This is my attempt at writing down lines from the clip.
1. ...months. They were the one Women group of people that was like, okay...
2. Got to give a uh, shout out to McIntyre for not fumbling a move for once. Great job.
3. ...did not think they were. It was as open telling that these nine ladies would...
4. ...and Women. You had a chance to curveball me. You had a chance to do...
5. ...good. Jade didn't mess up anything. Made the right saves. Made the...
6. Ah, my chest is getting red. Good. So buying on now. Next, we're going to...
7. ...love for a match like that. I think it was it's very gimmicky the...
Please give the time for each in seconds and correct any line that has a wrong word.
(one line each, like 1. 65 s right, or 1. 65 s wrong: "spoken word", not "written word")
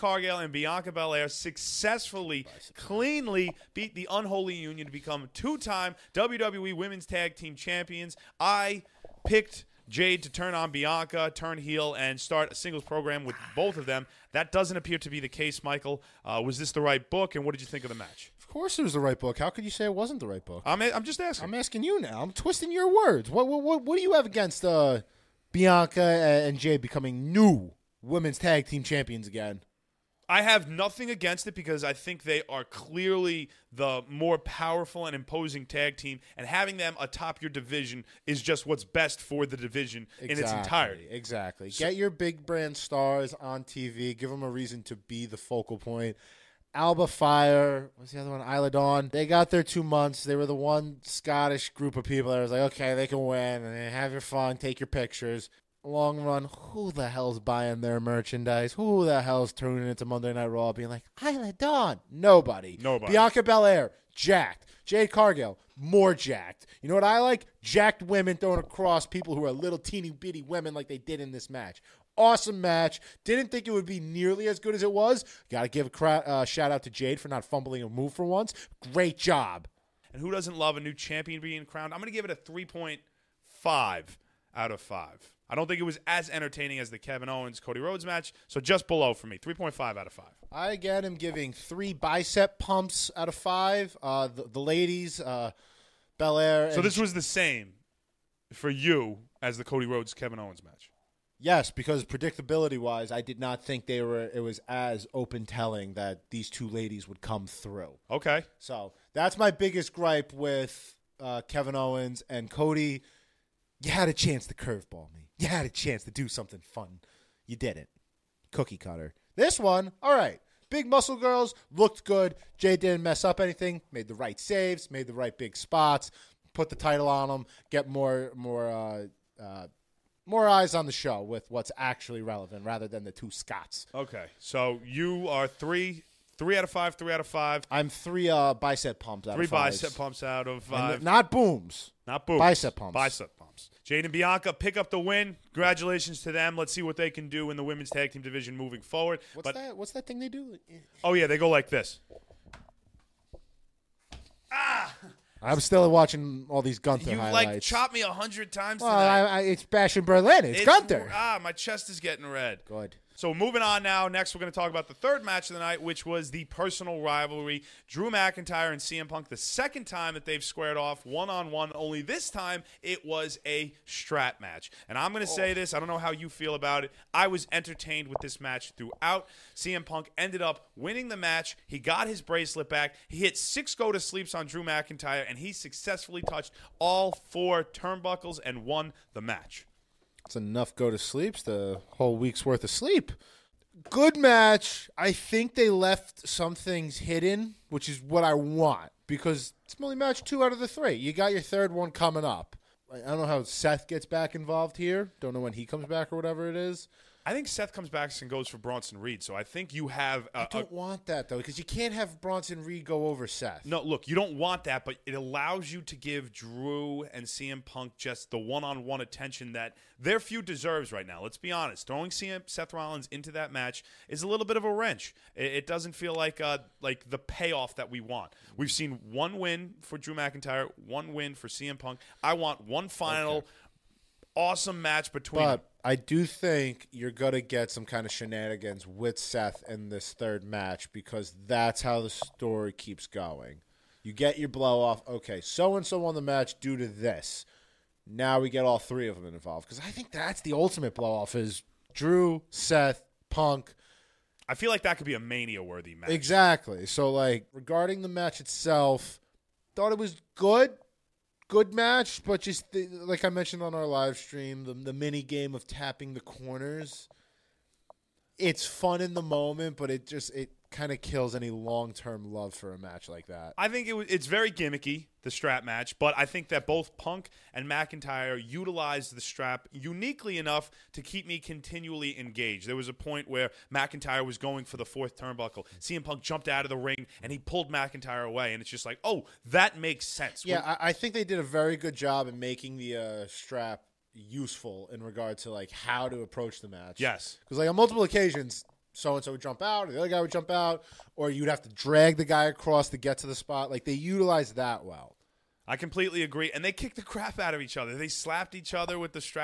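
1. 49 s wrong: "Scottish", not "Women"
2. 75 s wrong: "Jade", not "McIntyre"
3. 103 s wrong: "two", not "nine"
4. 112 s wrong: "Cody", not "Women"
5. 122 s right
6. 161 s wrong: "moving", not "buying"
7. 272 s right.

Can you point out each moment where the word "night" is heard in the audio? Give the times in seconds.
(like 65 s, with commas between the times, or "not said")
60 s, 165 s.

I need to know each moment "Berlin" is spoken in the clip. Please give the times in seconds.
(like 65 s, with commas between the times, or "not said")
160 s.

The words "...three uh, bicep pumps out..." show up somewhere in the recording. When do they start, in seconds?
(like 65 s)
137 s.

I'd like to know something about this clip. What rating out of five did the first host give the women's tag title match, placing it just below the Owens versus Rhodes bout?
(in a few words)
3.5.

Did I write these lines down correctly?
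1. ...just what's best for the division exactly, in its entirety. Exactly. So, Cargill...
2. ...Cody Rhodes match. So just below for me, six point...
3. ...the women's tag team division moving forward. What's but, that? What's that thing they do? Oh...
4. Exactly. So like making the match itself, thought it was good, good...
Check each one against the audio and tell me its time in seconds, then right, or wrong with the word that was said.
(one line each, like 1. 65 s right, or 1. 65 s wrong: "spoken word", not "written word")
1. 38 s wrong: "Get", not "Cargill"
2. 87 s wrong: "three", not "six"
3. 147 s right
4. 256 s wrong: "regarding", not "making".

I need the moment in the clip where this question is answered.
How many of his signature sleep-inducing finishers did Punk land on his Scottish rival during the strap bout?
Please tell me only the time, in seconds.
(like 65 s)
183 s.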